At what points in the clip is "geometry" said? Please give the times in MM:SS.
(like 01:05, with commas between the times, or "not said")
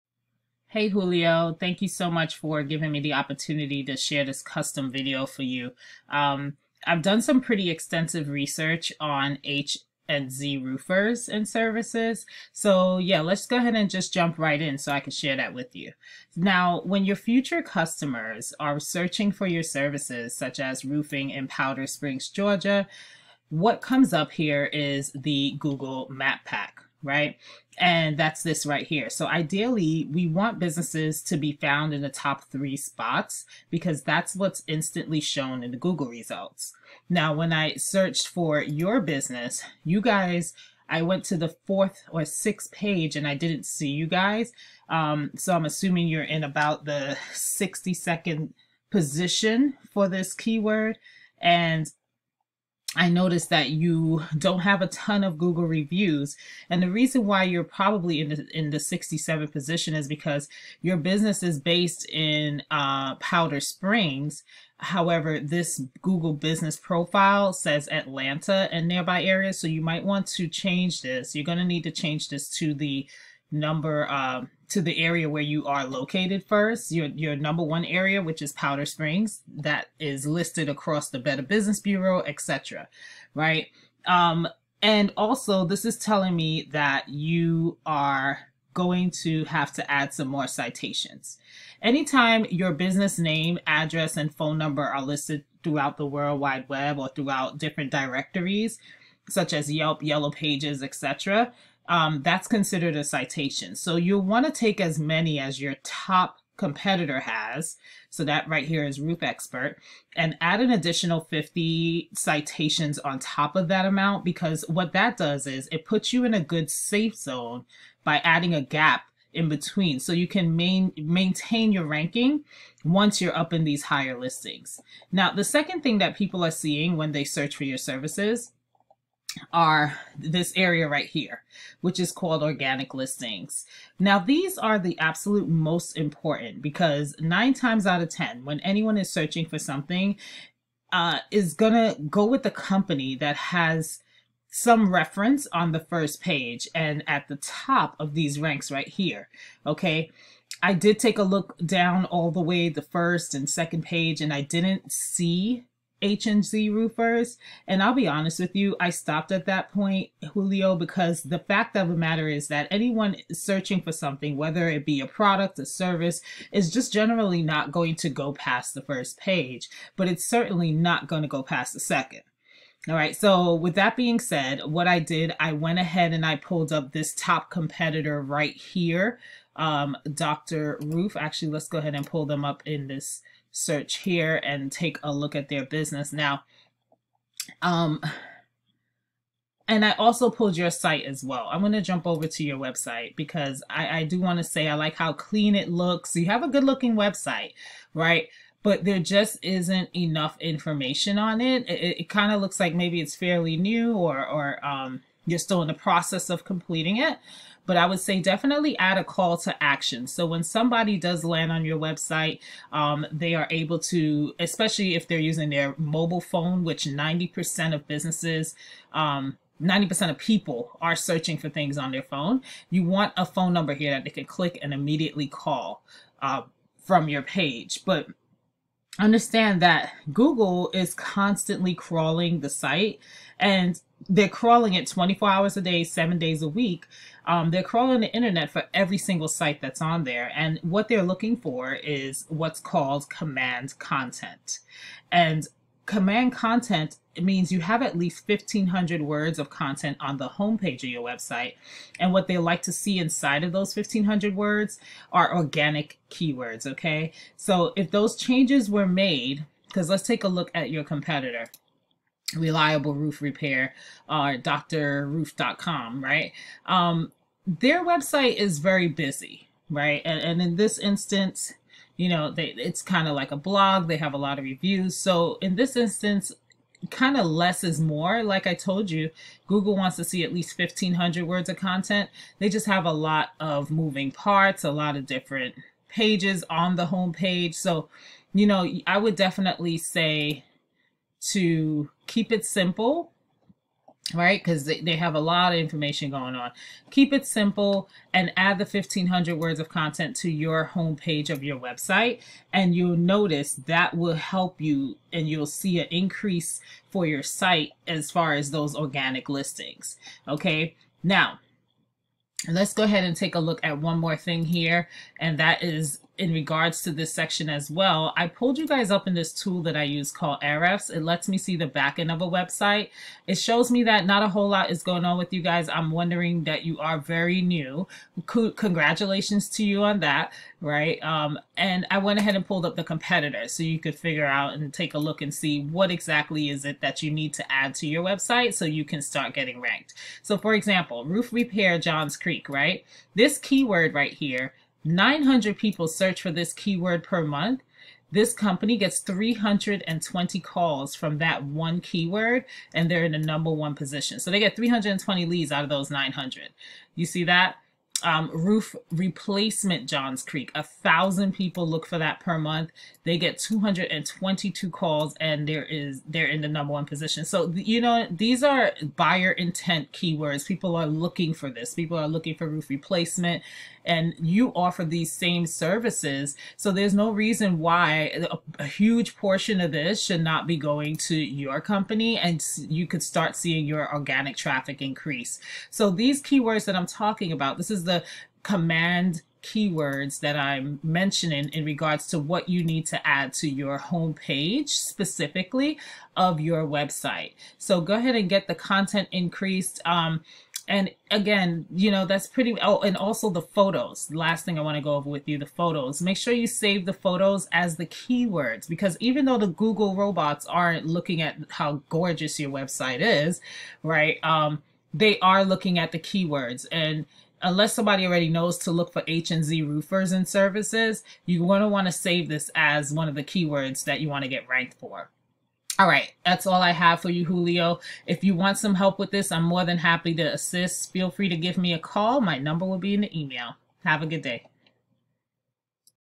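not said.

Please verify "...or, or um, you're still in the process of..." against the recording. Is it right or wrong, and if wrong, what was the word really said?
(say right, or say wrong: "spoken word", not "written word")
right.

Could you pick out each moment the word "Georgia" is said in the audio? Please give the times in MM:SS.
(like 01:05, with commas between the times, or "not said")
00:22.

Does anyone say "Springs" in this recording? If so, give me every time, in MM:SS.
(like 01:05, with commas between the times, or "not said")
00:21, 01:03, 01:18.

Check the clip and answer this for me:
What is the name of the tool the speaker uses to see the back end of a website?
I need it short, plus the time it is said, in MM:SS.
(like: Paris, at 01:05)
Ahrefs, at 05:20.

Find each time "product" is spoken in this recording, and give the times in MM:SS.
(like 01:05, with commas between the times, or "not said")
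02:45.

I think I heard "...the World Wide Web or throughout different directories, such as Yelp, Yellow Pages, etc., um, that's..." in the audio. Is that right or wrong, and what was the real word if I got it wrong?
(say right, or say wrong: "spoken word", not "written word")
right.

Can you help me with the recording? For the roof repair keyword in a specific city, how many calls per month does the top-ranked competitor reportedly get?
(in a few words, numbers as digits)
320.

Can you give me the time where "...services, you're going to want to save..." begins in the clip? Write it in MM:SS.
07:00.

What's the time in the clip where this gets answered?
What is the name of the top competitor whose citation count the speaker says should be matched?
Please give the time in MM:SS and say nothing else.
01:49.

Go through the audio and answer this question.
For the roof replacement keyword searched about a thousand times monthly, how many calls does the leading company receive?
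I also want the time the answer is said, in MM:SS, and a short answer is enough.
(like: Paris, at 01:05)
222, at 06:03.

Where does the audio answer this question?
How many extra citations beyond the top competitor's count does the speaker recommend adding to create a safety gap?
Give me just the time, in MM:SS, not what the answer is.
01:50.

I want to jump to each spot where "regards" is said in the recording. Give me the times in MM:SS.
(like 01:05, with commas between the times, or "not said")
05:16, 06:31.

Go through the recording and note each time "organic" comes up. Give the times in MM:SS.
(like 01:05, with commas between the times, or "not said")
02:12, 04:15, 05:08, 06:23.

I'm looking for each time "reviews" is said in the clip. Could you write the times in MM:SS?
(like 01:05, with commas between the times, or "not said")
00:55, 04:34.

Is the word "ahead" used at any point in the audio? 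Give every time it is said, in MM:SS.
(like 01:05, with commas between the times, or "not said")
00:13, 02:55, 03:01, 05:12, 05:32, 06:37.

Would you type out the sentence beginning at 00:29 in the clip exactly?
So ideally, we want businesses to be found in the top three spots because that's what's instantly shown in the Google results.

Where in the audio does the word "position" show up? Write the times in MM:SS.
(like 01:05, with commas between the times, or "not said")
00:48, 00:59, 05:53, 06:06.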